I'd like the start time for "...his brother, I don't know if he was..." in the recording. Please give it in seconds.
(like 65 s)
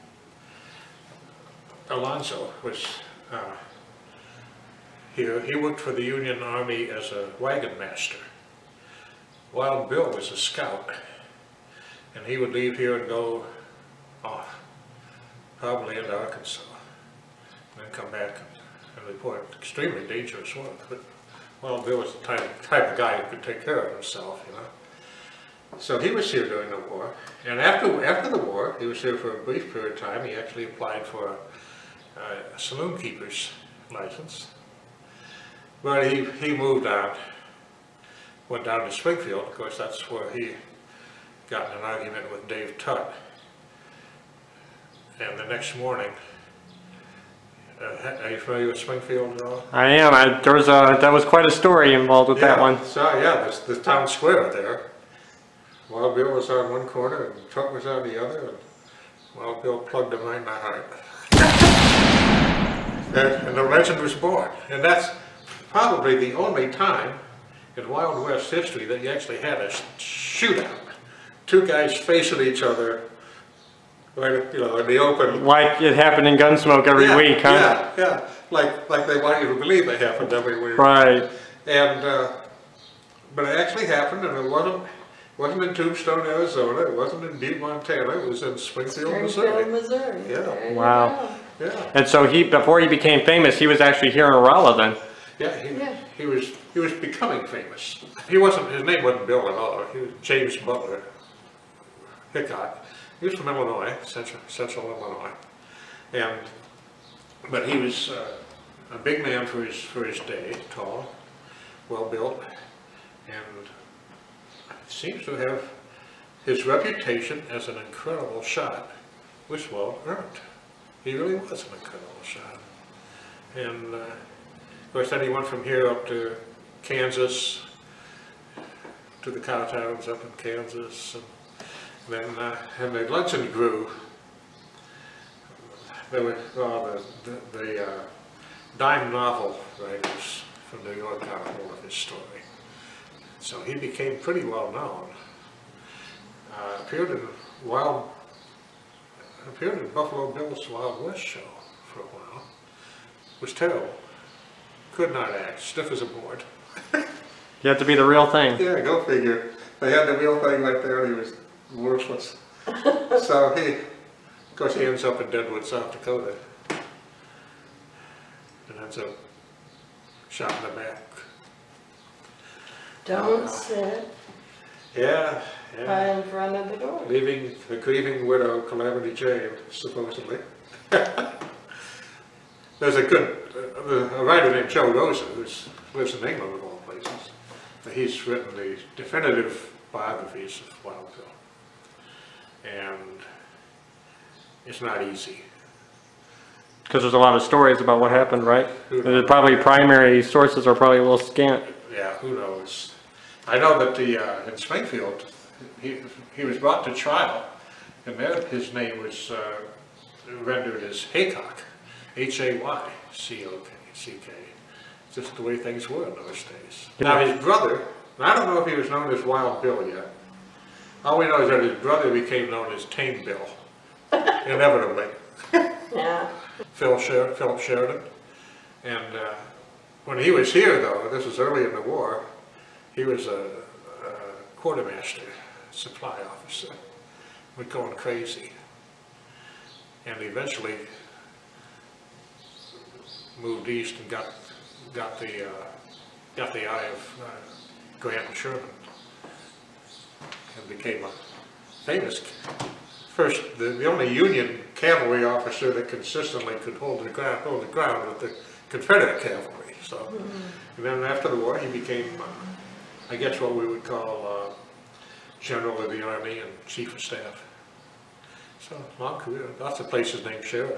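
217 s.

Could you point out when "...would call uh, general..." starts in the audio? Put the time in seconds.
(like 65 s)
263 s.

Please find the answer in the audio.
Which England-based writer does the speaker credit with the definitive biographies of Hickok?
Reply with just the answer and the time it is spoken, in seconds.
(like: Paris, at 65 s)
Joe Rosa, at 184 s.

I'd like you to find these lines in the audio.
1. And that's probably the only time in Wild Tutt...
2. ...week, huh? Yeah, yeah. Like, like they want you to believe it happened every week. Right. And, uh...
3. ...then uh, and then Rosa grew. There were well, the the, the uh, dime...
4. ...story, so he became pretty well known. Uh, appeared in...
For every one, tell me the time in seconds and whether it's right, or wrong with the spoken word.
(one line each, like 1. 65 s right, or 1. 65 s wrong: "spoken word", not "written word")
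1. 64 s wrong: "West", not "Tutt"
2. 77 s right
3. 132 s wrong: "Lunson", not "Rosa"
4. 141 s right.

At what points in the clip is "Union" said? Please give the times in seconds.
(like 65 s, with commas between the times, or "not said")
6 s, 254 s.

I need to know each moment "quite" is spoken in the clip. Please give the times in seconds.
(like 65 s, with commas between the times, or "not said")
51 s.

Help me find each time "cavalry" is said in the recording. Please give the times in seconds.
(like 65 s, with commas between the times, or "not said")
254 s, 259 s.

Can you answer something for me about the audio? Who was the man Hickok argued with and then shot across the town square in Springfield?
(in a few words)
Dave Tutt.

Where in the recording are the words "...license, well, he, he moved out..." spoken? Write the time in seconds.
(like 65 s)
33 s.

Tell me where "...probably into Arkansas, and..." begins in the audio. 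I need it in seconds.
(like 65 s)
15 s.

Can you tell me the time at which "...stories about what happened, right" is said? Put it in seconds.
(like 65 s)
197 s.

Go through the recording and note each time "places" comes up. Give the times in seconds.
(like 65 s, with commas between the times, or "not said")
186 s, 269 s.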